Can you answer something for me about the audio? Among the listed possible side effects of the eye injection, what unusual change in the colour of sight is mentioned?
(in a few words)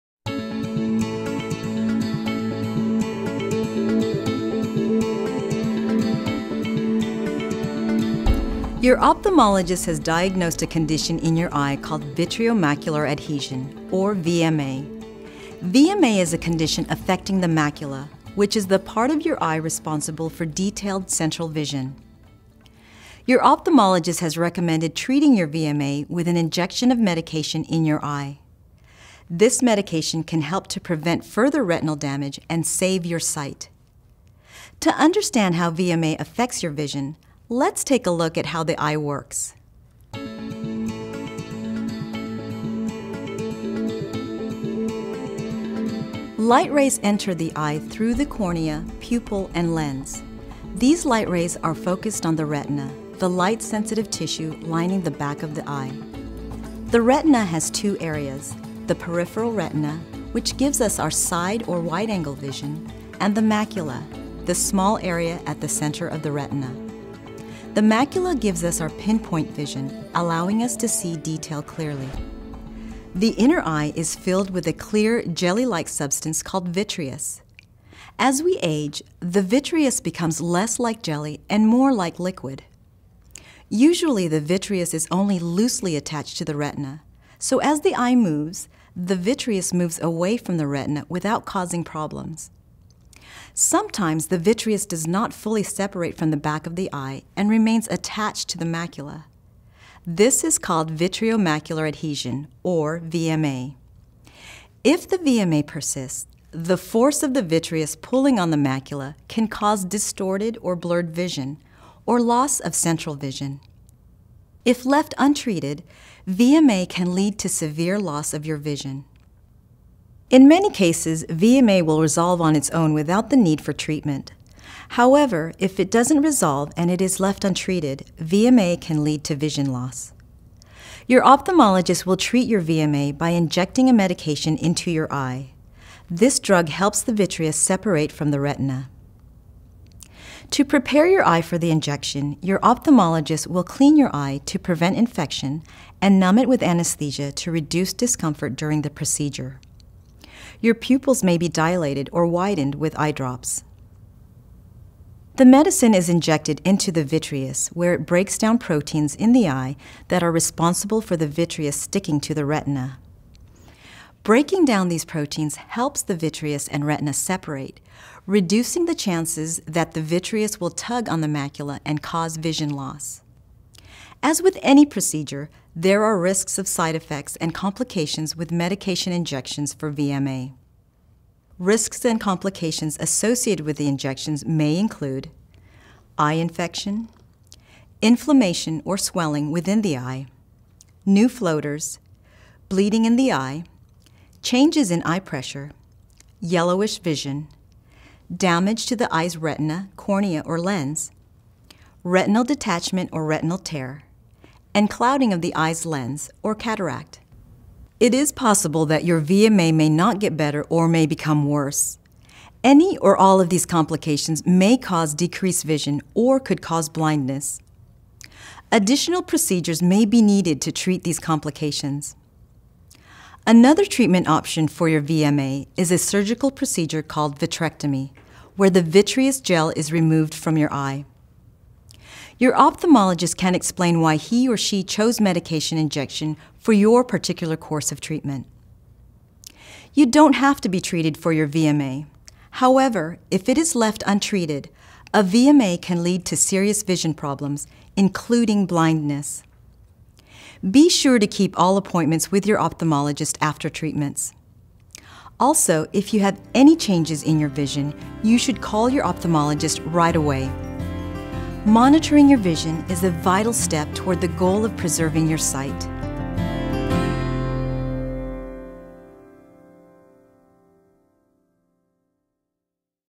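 yellowish vision.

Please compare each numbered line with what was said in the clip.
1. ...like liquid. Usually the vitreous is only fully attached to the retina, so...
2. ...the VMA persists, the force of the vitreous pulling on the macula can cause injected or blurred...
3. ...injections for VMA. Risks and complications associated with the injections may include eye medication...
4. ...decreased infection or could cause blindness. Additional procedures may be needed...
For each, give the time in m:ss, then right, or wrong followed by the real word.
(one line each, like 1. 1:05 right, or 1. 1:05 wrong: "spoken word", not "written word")
1. 1:21 wrong: "loosely", not "fully"
2. 1:45 wrong: "distorted", not "injected"
3. 2:59 wrong: "infection", not "medication"
4. 3:35 wrong: "vision", not "infection".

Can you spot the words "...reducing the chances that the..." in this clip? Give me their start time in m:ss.
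2:48.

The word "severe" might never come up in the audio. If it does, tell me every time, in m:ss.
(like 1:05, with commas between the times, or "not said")
1:57.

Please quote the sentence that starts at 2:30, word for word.
Your pupils may be dilated or widened with eye drops.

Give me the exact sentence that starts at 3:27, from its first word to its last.
It is possible that your VMA may not get better or may become worse.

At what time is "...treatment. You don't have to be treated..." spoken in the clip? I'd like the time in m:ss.
3:58.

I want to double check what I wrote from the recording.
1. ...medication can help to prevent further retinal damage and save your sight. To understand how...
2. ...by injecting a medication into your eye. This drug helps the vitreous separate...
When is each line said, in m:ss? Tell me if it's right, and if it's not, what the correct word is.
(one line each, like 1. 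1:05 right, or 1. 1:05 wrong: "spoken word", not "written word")
1. 0:29 right
2. 2:13 right.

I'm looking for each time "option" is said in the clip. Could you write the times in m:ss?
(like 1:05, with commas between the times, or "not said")
3:44.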